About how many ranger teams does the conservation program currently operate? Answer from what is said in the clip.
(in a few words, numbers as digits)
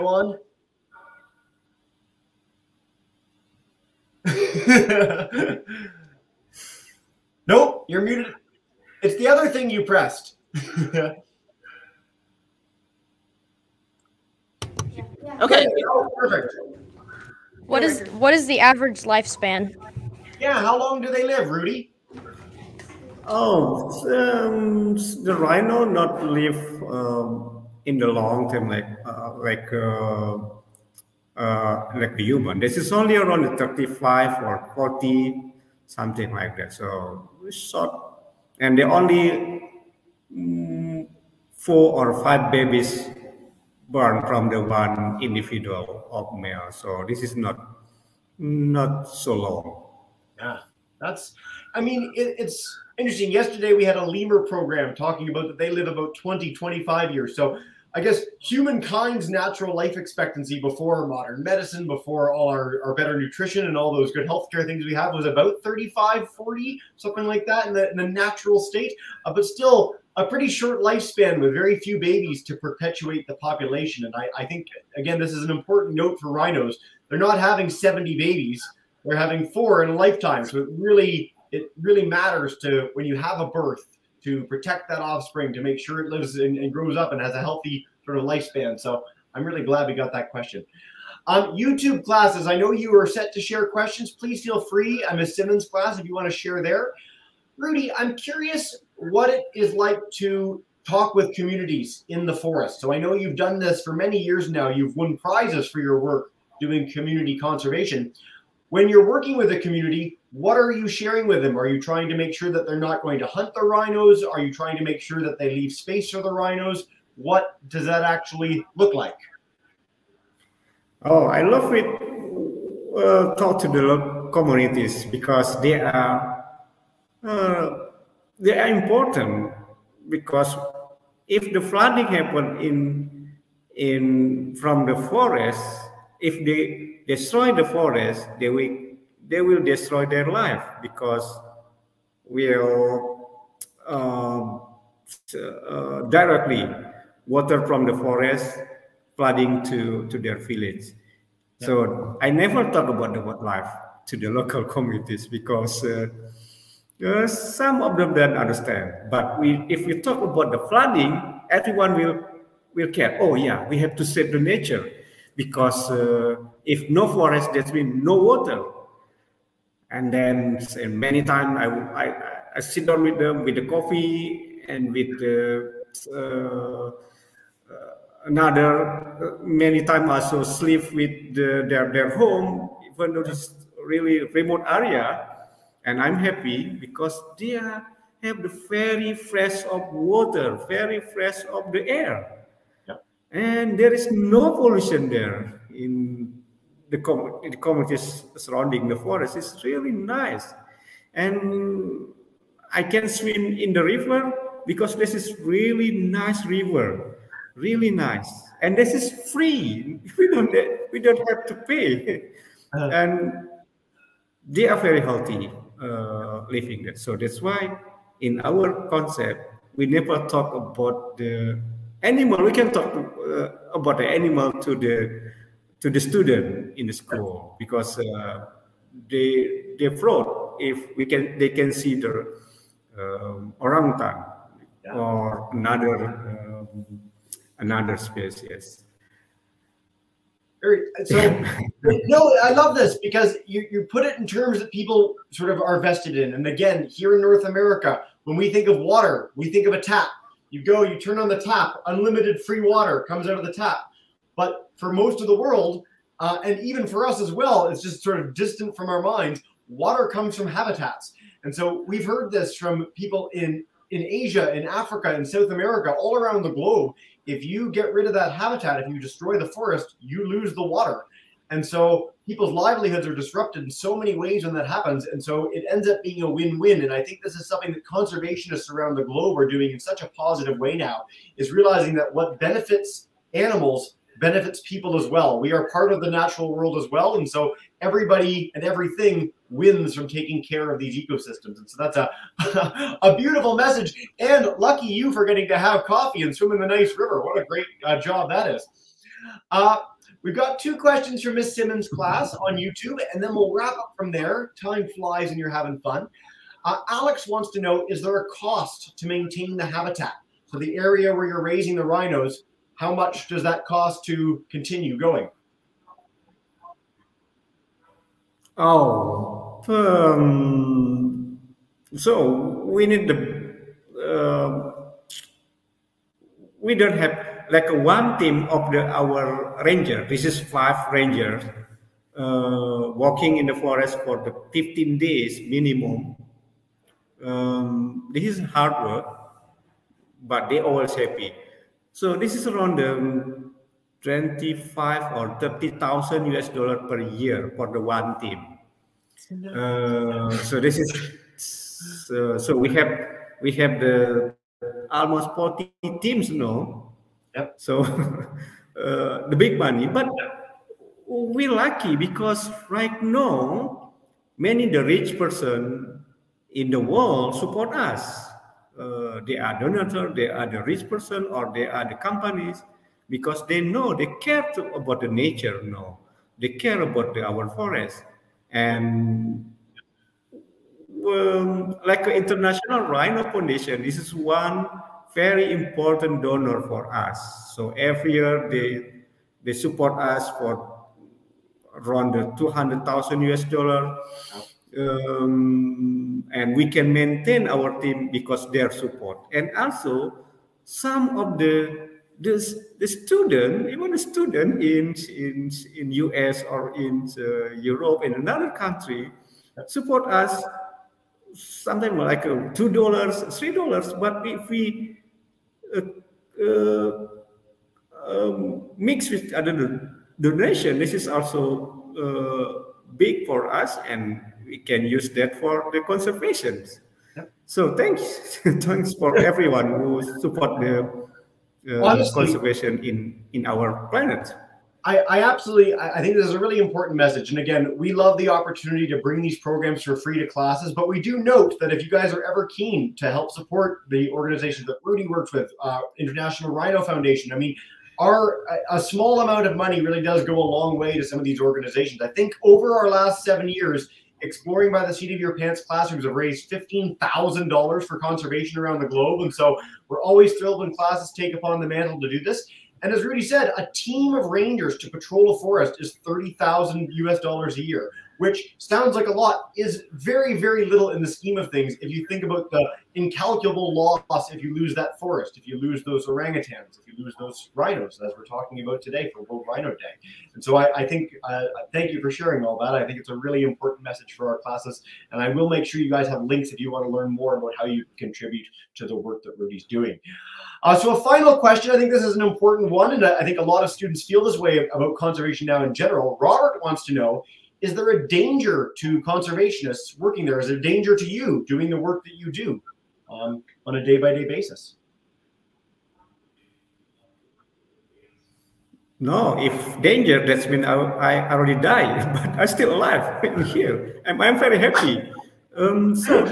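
Almost 40.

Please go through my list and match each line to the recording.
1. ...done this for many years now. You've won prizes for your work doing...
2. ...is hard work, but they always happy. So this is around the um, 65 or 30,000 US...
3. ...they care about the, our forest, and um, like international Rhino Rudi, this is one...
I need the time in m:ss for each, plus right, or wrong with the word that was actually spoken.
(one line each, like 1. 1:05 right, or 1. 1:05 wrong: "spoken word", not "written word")
1. 1:43 right
2. 5:38 wrong: "25", not "65"
3. 6:16 wrong: "Foundation", not "Rudi".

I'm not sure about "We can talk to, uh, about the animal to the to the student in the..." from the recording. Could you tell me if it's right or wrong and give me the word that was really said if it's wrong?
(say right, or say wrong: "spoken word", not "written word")
right.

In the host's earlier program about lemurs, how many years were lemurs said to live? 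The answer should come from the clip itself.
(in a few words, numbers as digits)
20 to 25.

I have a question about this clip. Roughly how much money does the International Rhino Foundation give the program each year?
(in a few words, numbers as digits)
$200,000.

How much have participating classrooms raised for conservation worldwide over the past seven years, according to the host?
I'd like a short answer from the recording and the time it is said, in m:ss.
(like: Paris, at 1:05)
$15,000, at 7:36.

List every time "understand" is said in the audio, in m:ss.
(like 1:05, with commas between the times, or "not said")
2:38.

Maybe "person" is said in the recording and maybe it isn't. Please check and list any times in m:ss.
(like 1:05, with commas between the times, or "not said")
6:05, 6:10.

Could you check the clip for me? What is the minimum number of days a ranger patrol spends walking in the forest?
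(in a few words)
15.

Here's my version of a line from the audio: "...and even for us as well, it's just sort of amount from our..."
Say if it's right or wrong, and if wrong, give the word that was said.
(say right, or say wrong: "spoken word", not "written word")
wrong: "distant", not "amount".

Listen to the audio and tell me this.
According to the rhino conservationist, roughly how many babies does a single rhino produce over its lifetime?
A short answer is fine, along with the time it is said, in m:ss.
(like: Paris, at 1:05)
4 or 5, at 0:41.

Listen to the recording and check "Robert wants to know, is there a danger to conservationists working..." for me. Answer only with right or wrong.
right.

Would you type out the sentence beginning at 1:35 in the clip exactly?
I'm a Simmons class if you want to share there.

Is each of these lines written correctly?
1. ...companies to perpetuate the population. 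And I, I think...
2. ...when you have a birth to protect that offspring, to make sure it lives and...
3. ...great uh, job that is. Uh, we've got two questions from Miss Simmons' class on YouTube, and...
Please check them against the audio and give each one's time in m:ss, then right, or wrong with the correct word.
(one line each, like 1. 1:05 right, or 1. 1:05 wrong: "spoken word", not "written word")
1. 1:11 wrong: "babies", not "companies"
2. 1:22 right
3. 4:57 right.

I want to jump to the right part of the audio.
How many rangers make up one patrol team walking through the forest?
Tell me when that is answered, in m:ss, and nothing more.
5:30.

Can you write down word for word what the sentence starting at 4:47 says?
And so everybody and everything wins from taking care of these ecosystems.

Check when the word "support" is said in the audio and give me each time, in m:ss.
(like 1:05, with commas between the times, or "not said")
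6:07, 6:29, 6:38, 6:49, 7:10, 7:23.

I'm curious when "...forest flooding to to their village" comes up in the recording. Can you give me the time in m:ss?
2:27.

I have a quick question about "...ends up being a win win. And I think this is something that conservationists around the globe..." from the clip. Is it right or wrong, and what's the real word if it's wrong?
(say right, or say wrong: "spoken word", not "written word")
right.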